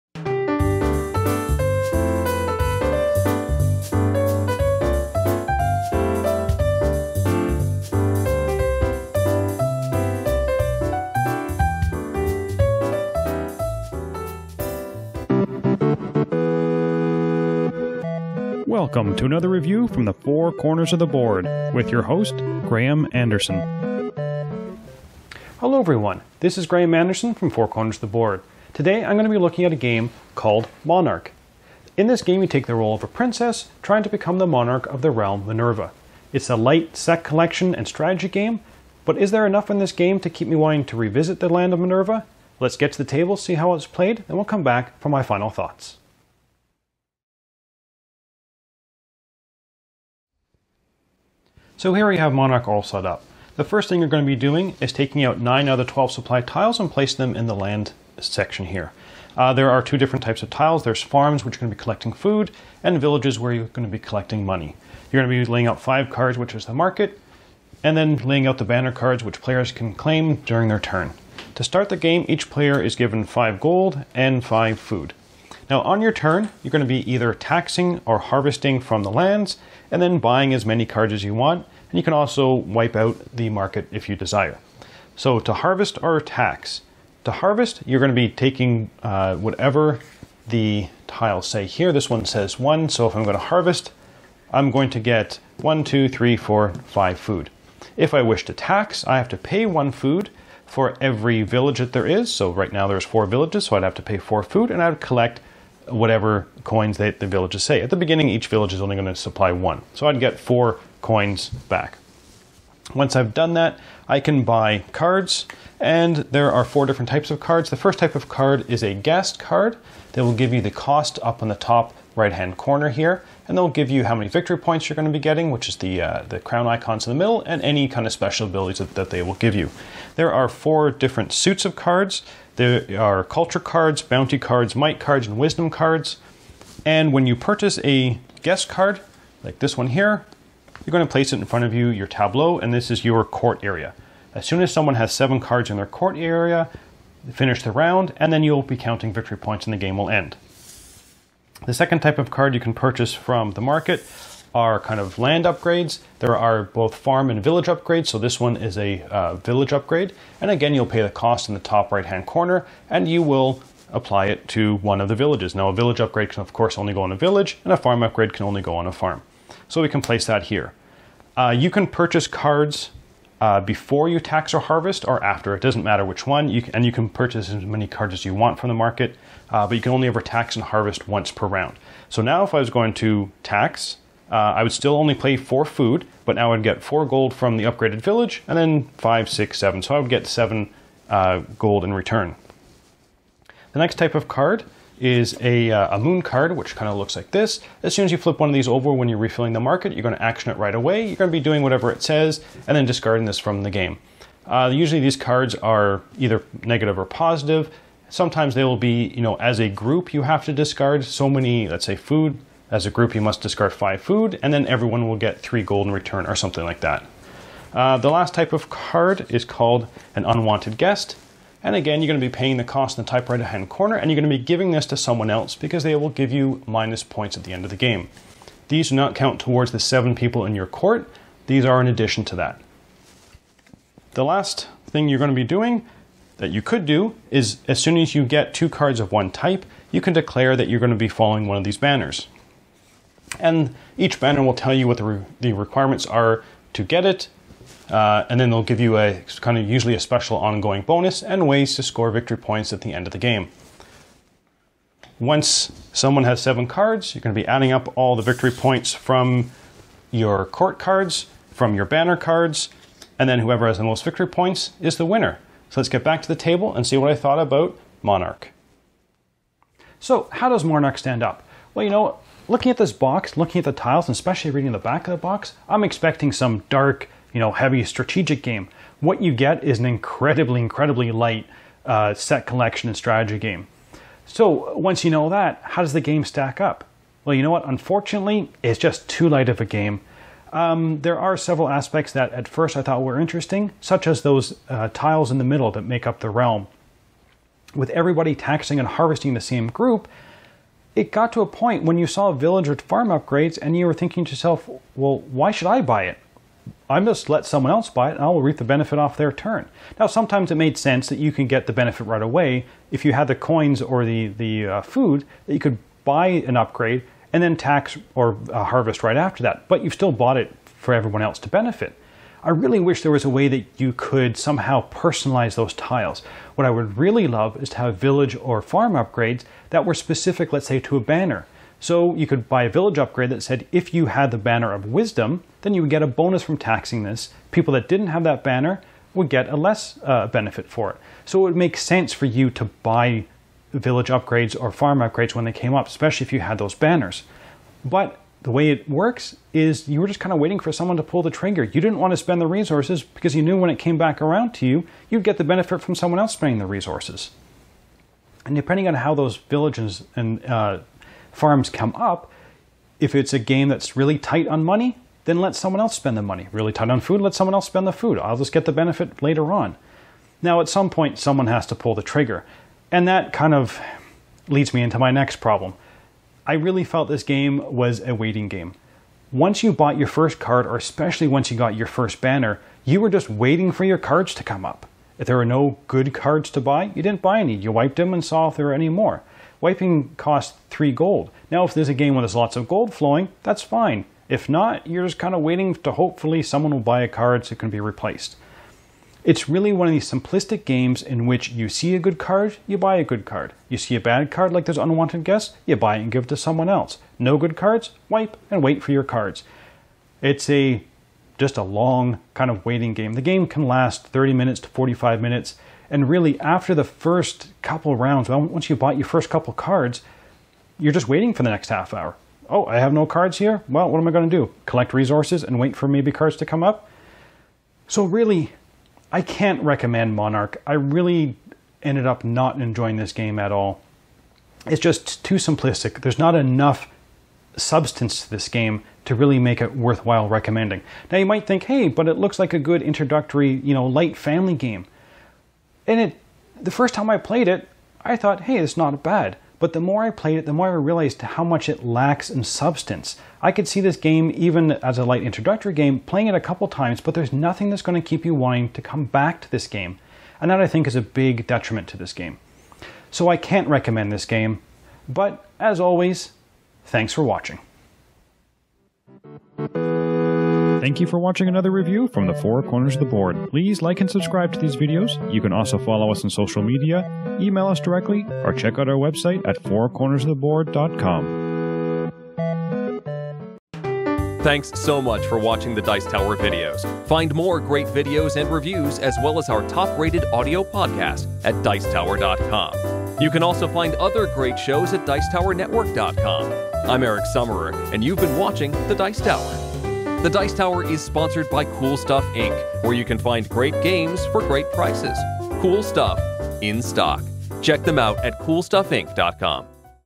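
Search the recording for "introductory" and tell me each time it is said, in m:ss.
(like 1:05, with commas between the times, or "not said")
7:22, 7:35.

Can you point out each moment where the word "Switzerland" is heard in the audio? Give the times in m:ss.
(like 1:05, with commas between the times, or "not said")
not said.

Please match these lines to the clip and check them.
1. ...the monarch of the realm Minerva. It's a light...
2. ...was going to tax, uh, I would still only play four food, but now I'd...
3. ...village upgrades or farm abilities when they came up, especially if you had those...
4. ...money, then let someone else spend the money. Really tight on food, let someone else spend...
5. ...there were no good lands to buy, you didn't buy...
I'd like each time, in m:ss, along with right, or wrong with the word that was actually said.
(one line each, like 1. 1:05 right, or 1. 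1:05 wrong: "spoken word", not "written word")
1. 0:34 right
2. 3:02 right
3. 5:43 wrong: "upgrades", not "abilities"
4. 6:04 right
5. 6:25 wrong: "cards", not "lands".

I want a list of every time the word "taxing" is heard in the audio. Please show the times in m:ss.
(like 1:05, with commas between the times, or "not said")
1:17, 4:58, 5:36.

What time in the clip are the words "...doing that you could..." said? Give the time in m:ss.
3:55.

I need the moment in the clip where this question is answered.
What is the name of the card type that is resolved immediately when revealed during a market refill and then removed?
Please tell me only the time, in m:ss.
3:15.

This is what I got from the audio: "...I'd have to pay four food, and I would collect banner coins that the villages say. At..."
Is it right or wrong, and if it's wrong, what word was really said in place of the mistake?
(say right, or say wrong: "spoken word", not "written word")
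wrong: "whatever", not "banner".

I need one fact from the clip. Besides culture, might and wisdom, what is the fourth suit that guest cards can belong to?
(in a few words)
bounty.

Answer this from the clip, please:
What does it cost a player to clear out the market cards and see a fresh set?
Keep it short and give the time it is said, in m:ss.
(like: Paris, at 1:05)
3 gold, at 6:30.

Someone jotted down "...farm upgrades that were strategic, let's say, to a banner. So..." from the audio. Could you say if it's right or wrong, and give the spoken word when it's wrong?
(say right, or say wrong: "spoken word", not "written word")
wrong: "specific", not "strategic".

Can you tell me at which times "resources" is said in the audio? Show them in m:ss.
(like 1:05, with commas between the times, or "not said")
5:52, 5:56, 7:04.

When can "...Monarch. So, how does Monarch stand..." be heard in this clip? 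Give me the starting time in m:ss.
4:28.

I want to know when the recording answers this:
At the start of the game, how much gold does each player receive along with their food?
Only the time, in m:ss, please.
1:13.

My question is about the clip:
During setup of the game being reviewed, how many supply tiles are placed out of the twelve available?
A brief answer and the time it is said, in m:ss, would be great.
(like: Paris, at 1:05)
9, at 0:55.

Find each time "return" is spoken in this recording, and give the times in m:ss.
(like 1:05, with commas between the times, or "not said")
3:11, 3:35.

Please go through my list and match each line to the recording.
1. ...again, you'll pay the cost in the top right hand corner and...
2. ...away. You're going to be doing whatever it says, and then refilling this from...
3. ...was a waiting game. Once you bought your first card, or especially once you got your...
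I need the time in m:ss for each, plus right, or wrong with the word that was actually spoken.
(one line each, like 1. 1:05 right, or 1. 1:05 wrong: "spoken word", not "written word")
1. 2:40 right
2. 3:20 wrong: "discarding", not "refilling"
3. 6:17 right.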